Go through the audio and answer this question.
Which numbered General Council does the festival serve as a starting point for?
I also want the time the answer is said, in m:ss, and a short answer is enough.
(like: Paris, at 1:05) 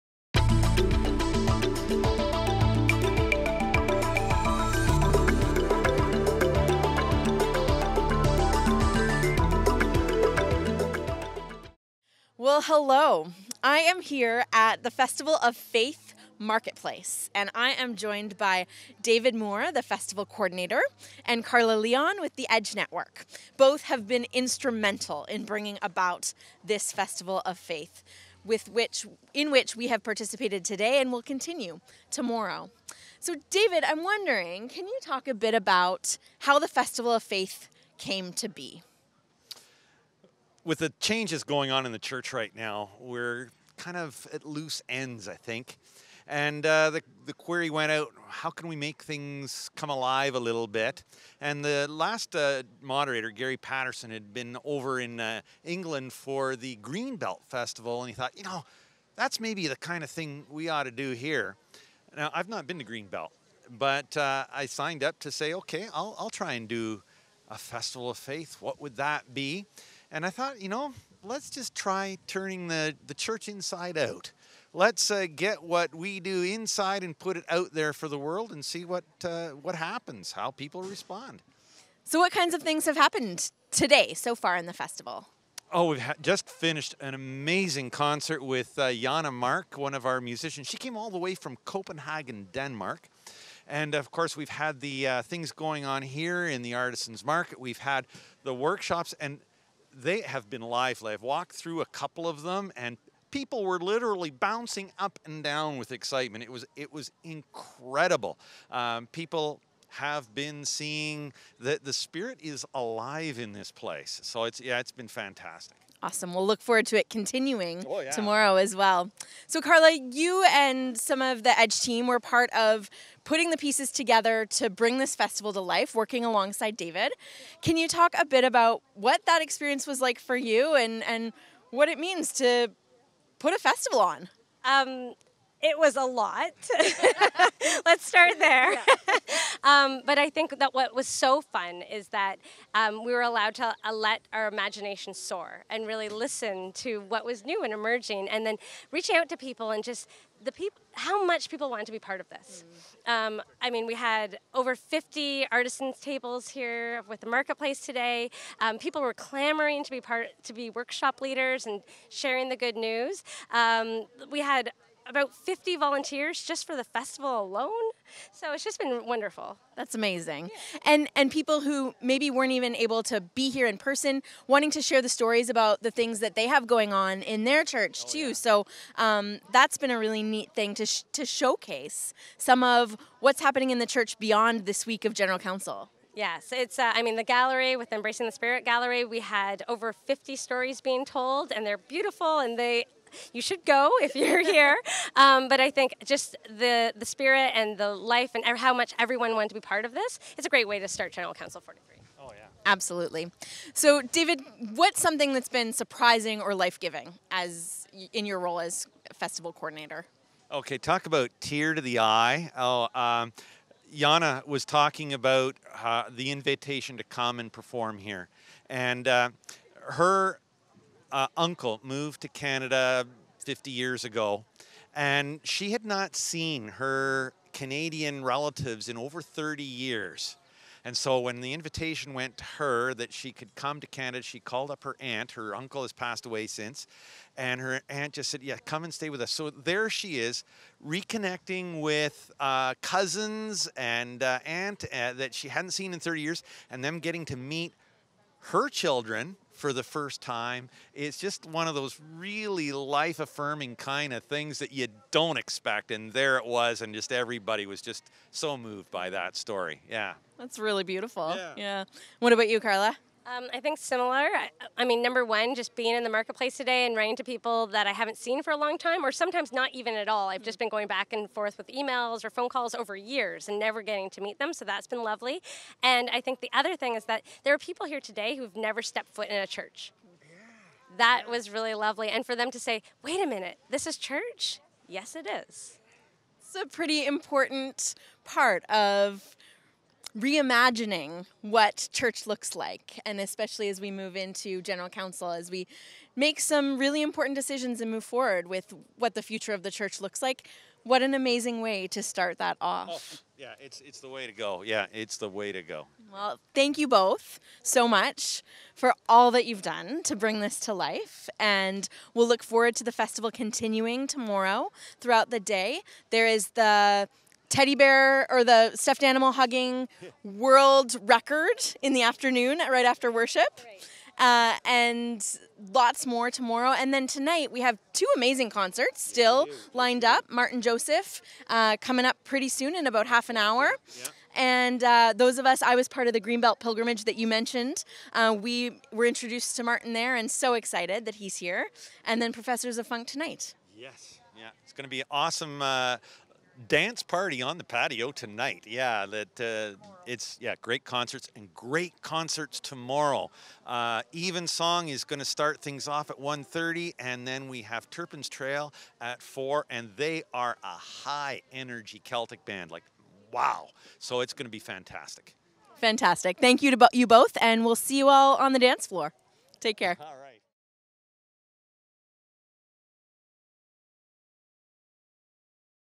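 General Council 43, at 3:21.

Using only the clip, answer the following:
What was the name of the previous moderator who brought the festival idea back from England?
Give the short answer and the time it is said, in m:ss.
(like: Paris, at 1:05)
Gary Paterson, at 0:53.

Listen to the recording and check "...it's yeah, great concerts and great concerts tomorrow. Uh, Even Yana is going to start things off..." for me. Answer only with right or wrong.
wrong.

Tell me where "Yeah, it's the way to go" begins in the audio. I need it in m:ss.
5:04.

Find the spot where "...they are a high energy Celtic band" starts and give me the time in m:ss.
5:59.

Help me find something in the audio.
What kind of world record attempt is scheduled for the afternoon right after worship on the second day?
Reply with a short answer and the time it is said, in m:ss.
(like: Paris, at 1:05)
stuffed animal hugging, at 5:18.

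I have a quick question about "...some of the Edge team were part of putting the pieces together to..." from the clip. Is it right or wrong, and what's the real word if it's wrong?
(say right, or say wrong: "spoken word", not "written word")
right.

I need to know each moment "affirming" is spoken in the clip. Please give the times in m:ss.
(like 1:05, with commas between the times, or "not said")
4:13.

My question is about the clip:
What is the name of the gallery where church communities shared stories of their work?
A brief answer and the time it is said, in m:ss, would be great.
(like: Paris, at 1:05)
Embracing the Spirit Gallery, at 3:07.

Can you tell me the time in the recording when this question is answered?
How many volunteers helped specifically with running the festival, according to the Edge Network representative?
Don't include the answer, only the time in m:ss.
2:45.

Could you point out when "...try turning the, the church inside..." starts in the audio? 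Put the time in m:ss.
1:11.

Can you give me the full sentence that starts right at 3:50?
And so when the invitation went to her that she could come to Canada, she called up her aunt.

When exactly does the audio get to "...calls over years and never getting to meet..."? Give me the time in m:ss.
4:32.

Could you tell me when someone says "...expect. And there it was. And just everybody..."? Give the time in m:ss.
4:15.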